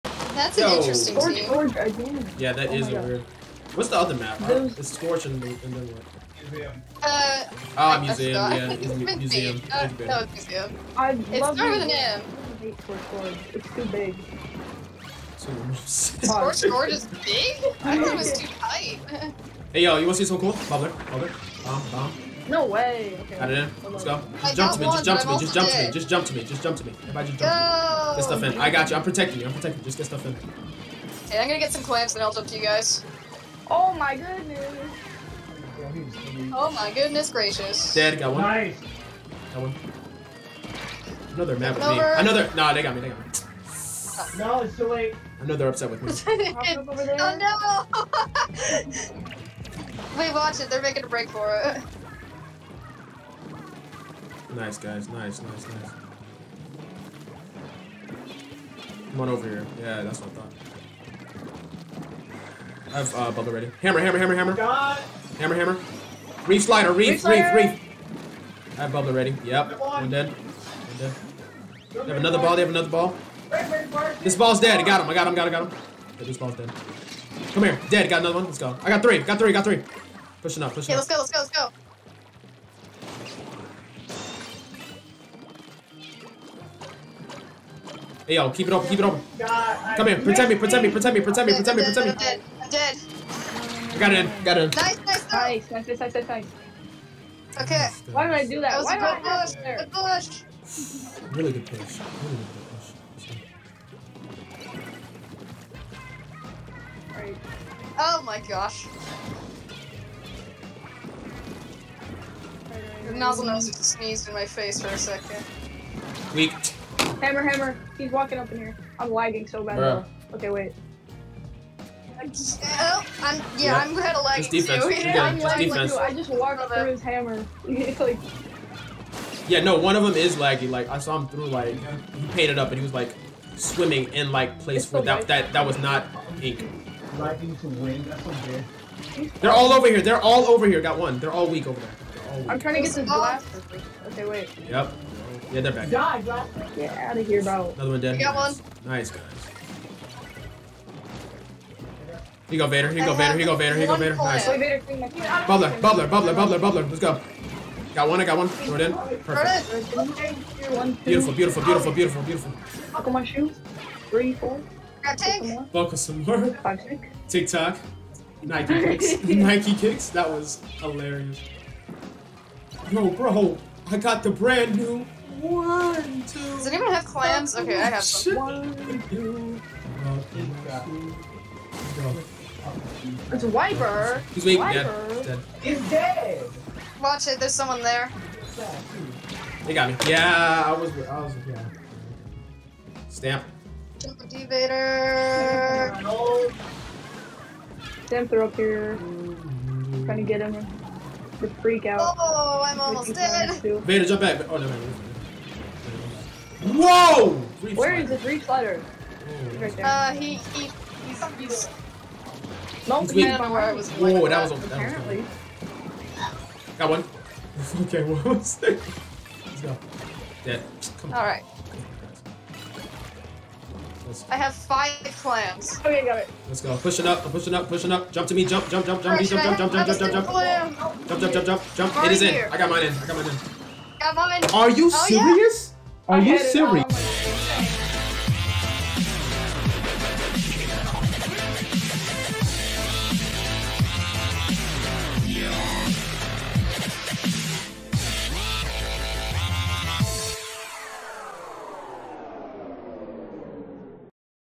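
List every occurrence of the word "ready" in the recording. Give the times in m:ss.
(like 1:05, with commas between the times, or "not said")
1:03, 1:09.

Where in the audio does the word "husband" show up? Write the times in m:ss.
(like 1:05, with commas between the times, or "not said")
not said.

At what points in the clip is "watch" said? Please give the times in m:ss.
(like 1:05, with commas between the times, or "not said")
0:50, 3:07.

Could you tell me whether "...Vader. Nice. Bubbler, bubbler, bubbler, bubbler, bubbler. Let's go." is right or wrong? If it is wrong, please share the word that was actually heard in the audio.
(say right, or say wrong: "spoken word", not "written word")
right.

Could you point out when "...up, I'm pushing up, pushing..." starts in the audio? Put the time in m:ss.
3:47.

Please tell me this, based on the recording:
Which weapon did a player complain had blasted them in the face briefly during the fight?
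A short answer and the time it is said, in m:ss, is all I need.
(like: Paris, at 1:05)
Nozzlenose, at 1:53.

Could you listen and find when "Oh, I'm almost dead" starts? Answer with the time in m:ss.
3:22.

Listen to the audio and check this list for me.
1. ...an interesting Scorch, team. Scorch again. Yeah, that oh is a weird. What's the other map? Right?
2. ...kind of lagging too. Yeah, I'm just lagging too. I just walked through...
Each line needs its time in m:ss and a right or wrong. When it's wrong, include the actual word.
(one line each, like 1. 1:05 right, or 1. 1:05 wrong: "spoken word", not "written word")
1. 0:00 right
2. 2:03 right.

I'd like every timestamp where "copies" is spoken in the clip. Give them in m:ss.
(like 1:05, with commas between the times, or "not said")
not said.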